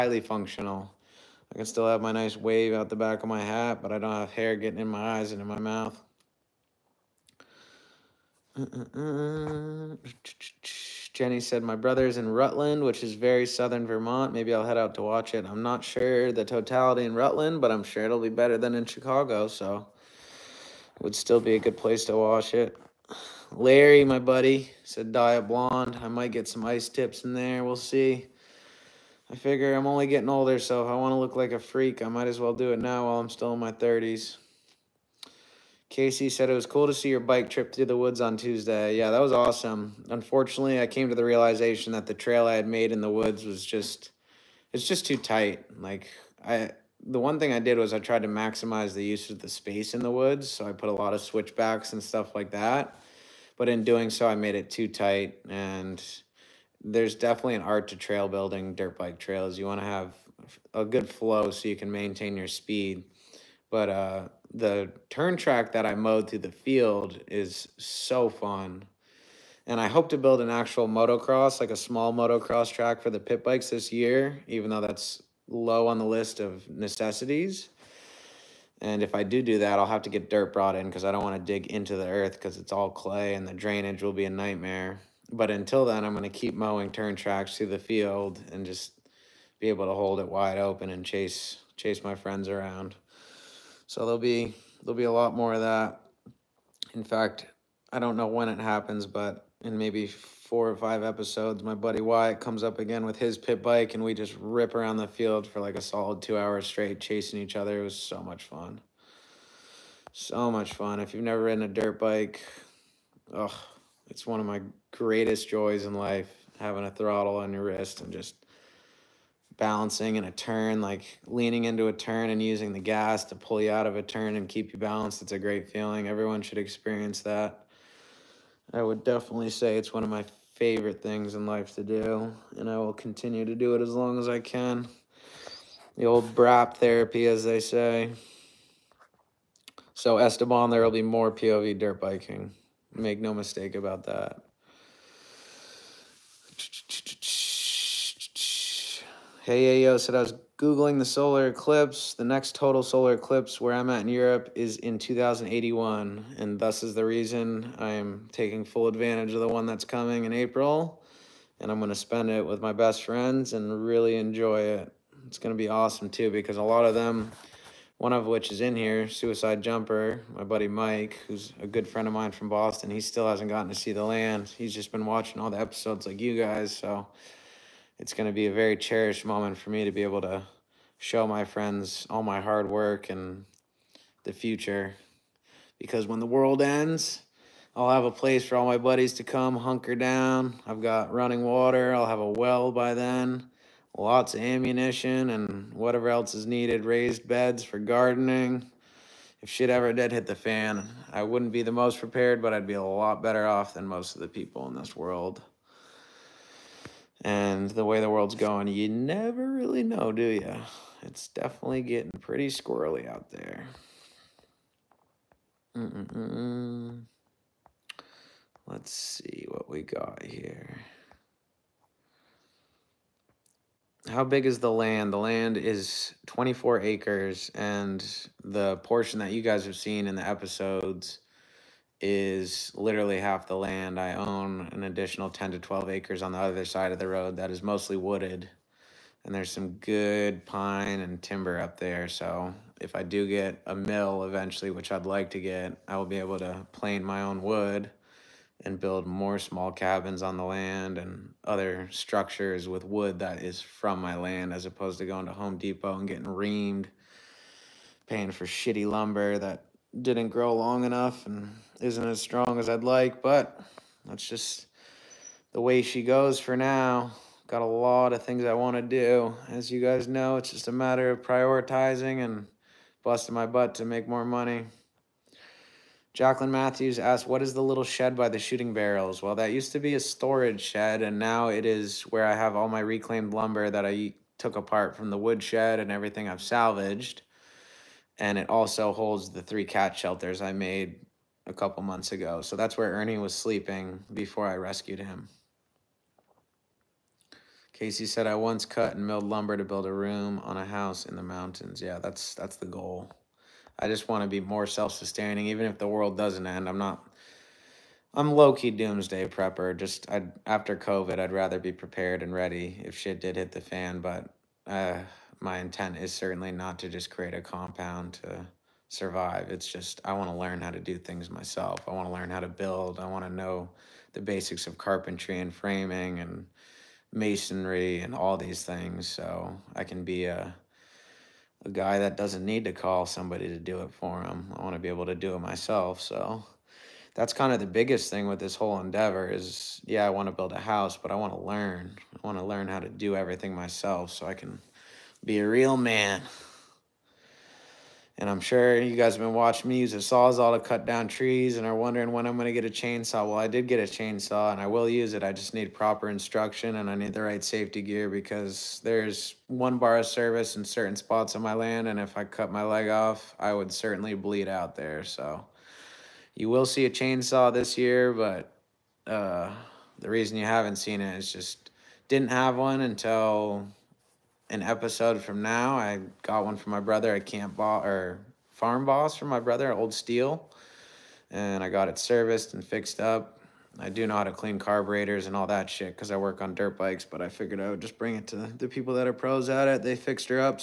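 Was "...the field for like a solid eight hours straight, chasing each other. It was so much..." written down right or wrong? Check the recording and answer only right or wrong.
wrong.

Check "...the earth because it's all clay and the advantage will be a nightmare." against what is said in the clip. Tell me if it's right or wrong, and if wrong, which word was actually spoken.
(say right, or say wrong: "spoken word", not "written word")
wrong: "drainage", not "advantage".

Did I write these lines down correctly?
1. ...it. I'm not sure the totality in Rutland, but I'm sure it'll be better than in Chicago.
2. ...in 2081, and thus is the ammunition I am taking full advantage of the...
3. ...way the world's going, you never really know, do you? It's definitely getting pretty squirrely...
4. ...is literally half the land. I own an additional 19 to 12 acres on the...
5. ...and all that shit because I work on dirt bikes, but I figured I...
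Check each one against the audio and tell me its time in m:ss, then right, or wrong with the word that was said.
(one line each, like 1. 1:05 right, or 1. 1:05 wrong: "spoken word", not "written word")
1. 0:15 right
2. 2:34 wrong: "reason", not "ammunition"
3. 3:27 right
4. 3:52 wrong: "10", not "19"
5. 6:25 right.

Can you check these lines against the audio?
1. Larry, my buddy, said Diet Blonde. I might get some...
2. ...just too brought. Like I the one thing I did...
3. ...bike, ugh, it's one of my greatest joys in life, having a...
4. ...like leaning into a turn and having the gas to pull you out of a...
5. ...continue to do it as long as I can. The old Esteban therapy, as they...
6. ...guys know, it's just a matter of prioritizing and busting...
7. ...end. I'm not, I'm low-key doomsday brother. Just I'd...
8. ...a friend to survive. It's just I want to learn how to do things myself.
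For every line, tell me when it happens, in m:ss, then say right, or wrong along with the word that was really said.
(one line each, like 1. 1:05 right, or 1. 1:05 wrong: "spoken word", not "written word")
1. 0:23 right
2. 0:44 wrong: "tight", not "brought"
3. 1:51 right
4. 2:00 wrong: "using", not "having"
5. 2:12 wrong: "BRAP", not "Esteban"
6. 4:29 right
7. 5:06 wrong: "prepper", not "brother"
8. 5:17 wrong: "compound", not "friend".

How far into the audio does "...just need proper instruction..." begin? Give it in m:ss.
5:55.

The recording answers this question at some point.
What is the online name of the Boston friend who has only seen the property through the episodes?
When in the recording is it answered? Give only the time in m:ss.
2:49.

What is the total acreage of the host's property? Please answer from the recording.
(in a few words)
24 acres.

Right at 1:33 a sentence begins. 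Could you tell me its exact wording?
So there'll be there'll be a lot more of that.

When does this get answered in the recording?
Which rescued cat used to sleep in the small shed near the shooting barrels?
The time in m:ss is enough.
4:52.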